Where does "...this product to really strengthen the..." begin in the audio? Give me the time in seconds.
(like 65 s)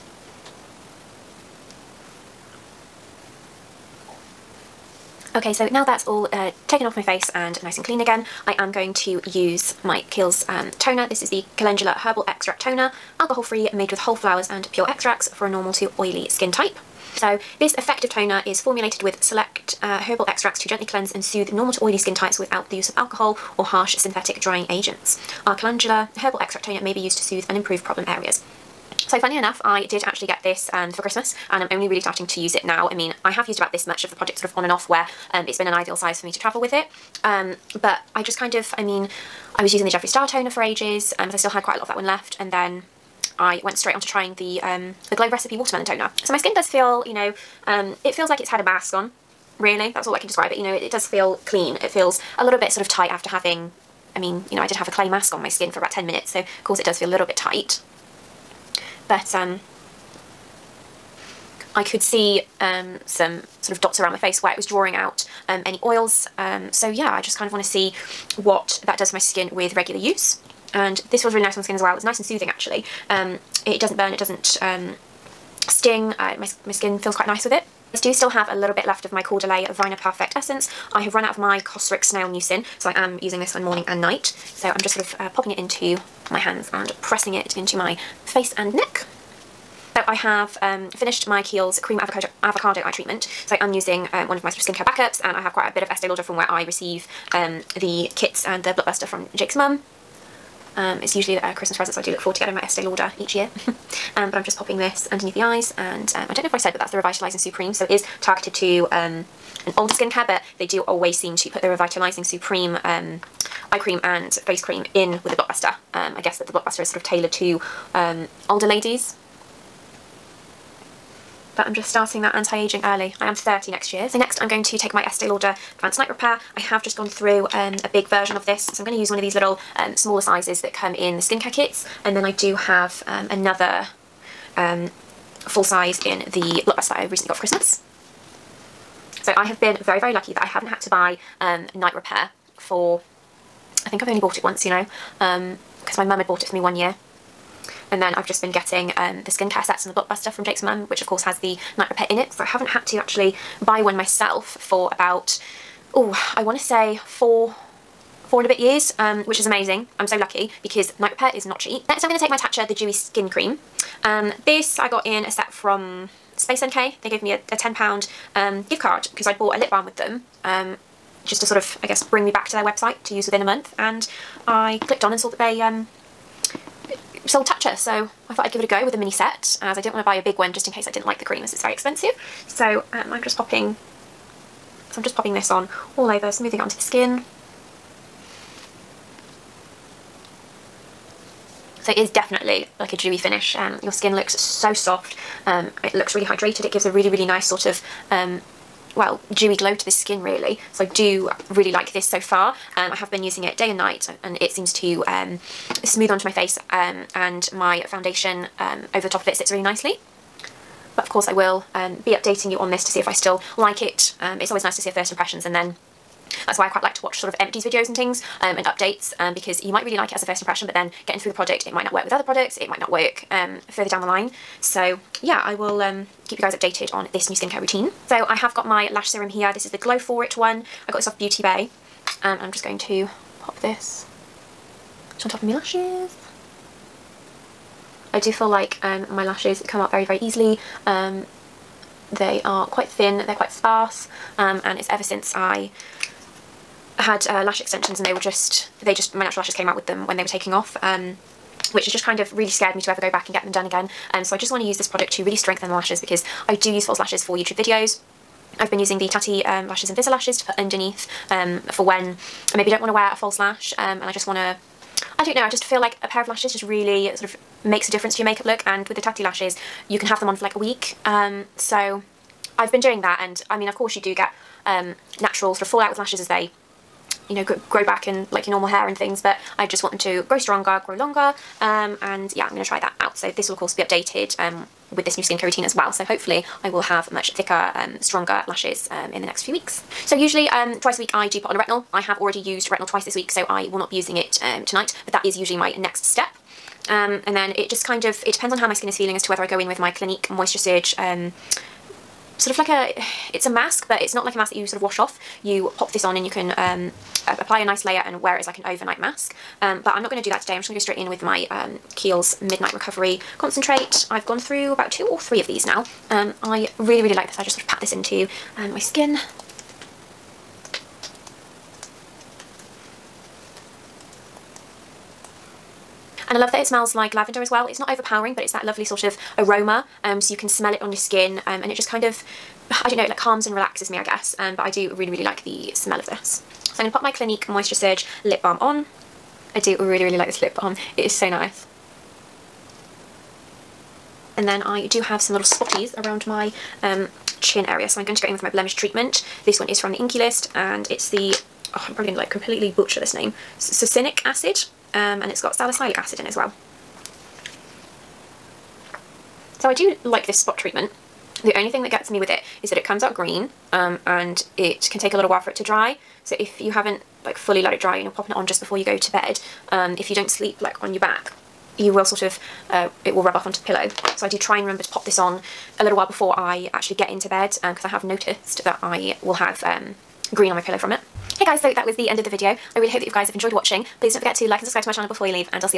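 254 s.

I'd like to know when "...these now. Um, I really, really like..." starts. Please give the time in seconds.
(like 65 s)
315 s.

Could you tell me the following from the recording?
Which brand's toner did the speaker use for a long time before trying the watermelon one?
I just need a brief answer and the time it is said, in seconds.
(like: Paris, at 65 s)
Jeffree Star, at 39 s.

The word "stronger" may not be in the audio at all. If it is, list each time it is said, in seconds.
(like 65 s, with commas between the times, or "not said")
280 s, 288 s.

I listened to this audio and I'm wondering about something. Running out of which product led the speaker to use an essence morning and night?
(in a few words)
COSRX Snail Mucin.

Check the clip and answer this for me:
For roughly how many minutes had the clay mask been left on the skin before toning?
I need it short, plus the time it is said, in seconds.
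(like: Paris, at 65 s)
10, at 55 s.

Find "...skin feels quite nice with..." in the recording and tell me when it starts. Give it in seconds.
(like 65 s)
76 s.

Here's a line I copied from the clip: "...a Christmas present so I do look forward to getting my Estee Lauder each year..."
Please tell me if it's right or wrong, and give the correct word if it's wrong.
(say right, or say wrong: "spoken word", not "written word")
right.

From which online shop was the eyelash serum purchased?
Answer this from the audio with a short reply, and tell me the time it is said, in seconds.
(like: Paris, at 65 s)
Beauty Bay, at 231 s.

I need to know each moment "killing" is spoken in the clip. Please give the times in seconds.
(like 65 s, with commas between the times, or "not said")
not said.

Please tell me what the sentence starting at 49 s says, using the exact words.
That's all I can describe it.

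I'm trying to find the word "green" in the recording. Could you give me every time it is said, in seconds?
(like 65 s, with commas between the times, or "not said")
363 s, 380 s.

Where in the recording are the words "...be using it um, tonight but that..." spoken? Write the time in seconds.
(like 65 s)
293 s.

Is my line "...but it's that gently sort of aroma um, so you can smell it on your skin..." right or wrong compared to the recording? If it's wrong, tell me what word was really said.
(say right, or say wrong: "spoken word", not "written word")
wrong: "lovely", not "gently".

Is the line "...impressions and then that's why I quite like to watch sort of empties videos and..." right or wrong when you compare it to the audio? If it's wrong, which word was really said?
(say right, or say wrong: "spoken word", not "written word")
right.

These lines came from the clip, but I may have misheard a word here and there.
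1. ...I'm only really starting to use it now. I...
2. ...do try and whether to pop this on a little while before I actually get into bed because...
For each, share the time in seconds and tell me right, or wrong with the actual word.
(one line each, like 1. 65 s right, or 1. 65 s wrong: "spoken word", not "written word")
1. 31 s right
2. 374 s wrong: "remember", not "whether".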